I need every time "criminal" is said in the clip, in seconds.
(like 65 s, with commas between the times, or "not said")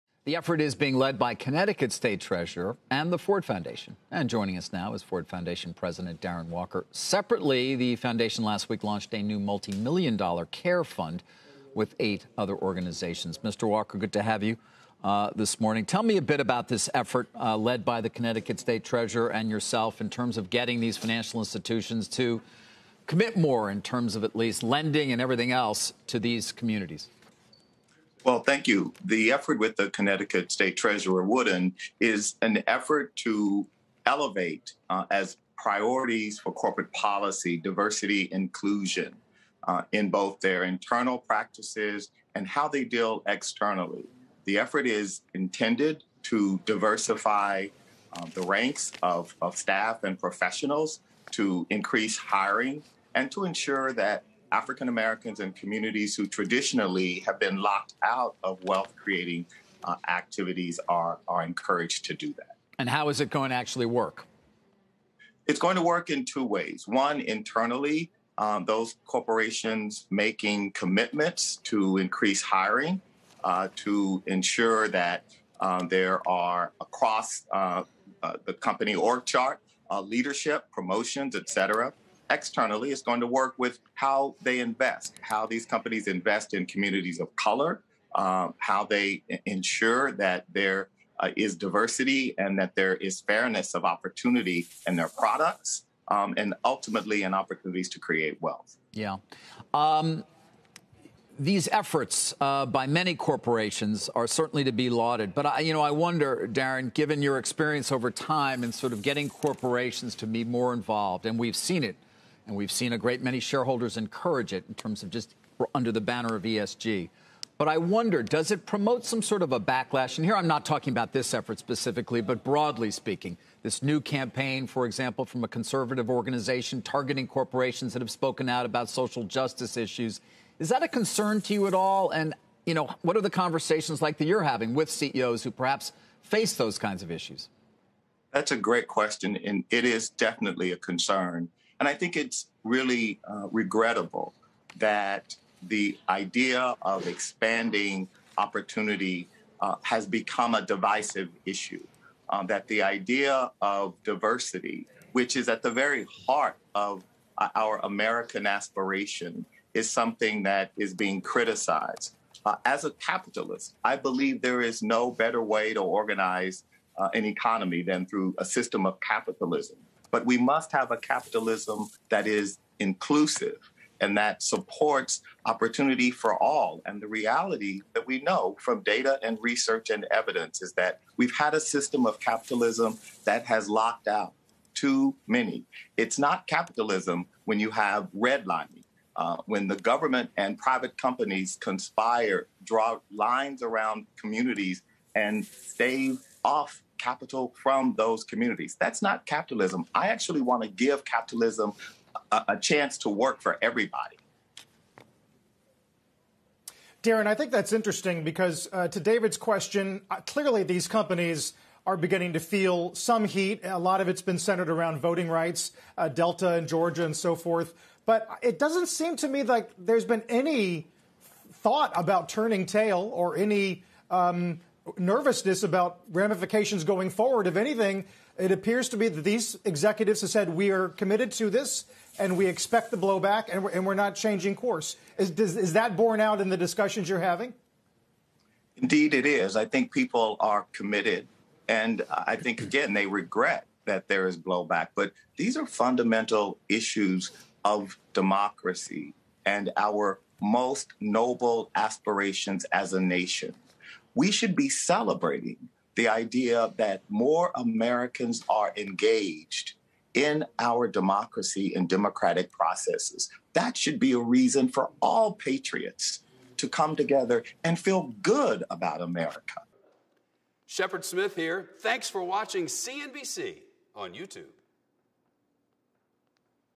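not said.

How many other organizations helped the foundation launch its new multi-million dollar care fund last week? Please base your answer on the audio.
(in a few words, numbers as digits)
8.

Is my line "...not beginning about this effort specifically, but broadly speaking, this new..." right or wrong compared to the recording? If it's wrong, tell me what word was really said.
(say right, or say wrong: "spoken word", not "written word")
wrong: "talking", not "beginning".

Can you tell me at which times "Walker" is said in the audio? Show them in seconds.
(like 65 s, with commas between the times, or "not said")
6 s, 13 s.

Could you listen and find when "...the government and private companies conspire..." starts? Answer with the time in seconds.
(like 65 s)
189 s.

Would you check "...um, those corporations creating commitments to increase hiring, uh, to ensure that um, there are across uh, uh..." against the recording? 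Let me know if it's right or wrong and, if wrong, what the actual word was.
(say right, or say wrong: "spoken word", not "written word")
wrong: "making", not "creating".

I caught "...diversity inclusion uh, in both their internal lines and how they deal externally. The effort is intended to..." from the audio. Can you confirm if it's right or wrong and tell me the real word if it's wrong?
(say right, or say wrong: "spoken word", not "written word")
wrong: "practices", not "lines".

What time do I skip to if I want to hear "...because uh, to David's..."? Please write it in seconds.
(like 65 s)
208 s.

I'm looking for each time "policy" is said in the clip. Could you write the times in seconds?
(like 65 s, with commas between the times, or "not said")
36 s.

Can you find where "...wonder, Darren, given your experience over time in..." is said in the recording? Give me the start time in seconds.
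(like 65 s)
105 s.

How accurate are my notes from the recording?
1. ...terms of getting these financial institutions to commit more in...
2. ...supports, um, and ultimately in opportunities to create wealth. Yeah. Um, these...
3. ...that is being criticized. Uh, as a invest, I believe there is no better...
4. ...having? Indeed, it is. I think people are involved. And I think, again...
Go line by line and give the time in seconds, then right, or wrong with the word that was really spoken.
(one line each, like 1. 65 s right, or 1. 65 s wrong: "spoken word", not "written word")
1. 20 s right
2. 95 s wrong: "products", not "supports"
3. 160 s wrong: "capitalist", not "invest"
4. 237 s wrong: "committed", not "involved".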